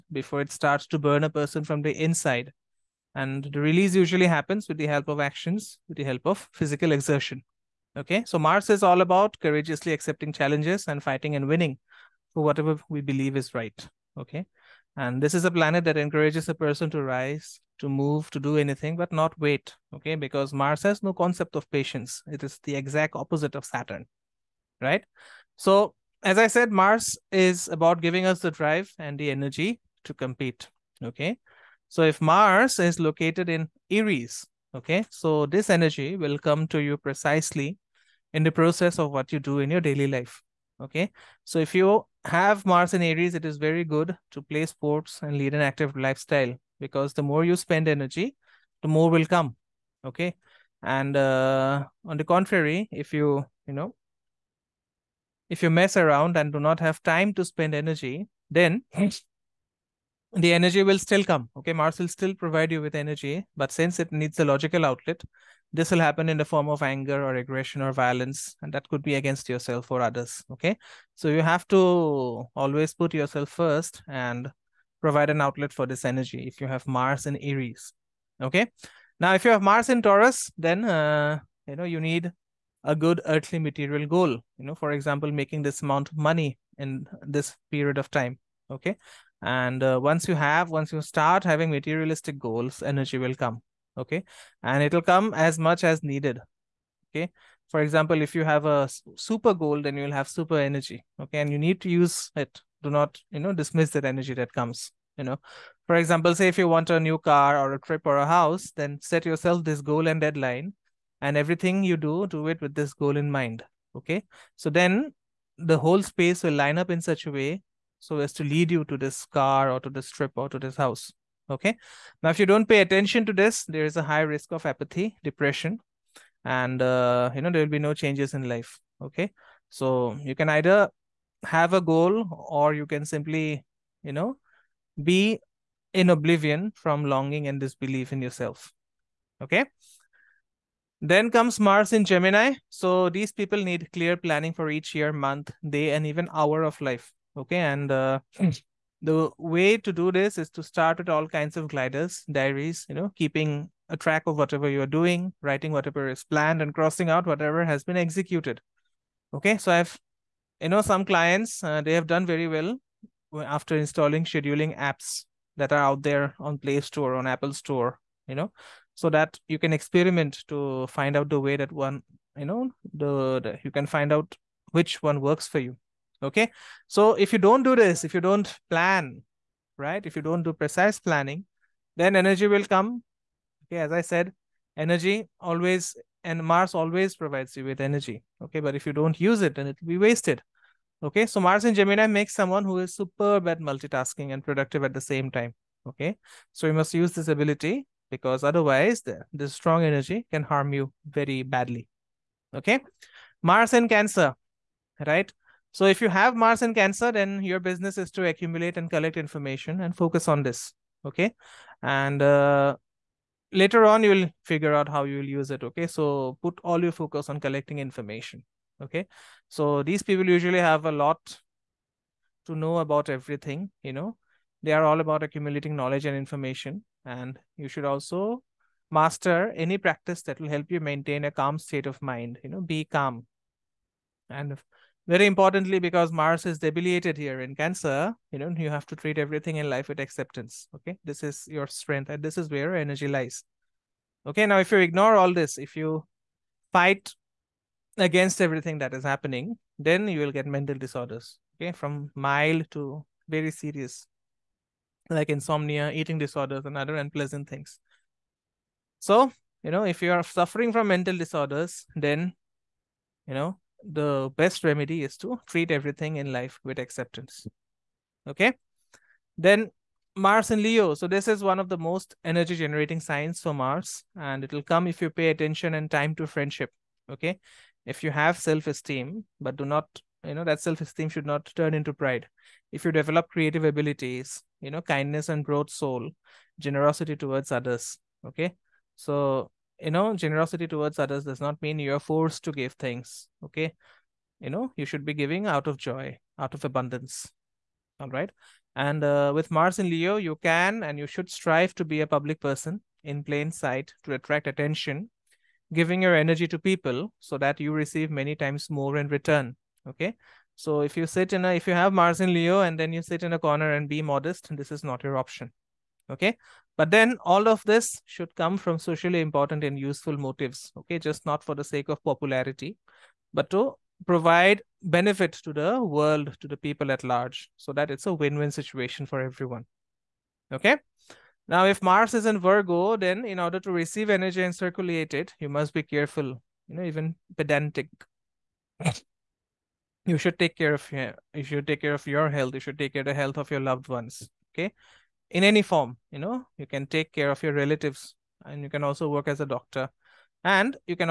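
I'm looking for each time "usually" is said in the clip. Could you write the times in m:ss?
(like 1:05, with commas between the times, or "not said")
0:03, 3:40.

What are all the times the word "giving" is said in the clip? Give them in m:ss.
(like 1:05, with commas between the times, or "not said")
0:28, 4:55, 5:05.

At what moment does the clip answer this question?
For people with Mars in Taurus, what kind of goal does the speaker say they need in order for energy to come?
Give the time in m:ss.
1:23.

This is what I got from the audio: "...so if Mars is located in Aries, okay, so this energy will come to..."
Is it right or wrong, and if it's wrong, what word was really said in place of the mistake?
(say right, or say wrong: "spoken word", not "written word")
right.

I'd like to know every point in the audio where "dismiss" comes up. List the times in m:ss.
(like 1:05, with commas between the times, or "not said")
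1:43.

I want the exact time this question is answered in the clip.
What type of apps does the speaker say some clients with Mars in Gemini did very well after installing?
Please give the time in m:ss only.
2:44.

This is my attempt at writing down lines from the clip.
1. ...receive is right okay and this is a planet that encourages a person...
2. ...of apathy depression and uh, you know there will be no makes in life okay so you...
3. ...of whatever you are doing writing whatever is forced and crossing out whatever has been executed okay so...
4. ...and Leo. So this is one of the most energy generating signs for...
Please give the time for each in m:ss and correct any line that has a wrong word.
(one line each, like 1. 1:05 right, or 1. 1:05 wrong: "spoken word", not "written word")
1. 0:13 wrong: "believe", not "receive"
2. 2:04 wrong: "changes", not "makes"
3. 2:34 wrong: "planned", not "forced"
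4. 4:30 right.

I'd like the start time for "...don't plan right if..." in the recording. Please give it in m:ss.
2:58.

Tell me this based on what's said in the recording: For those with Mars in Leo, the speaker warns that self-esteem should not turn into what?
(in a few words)
Pride.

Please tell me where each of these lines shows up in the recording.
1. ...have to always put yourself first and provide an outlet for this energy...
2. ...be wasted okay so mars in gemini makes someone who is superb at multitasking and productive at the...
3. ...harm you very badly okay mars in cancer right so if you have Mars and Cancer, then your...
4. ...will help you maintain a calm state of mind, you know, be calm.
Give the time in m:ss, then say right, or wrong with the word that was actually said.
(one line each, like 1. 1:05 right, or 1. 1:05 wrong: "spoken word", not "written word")
1. 1:11 right
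2. 3:09 right
3. 3:20 right
4. 3:50 right.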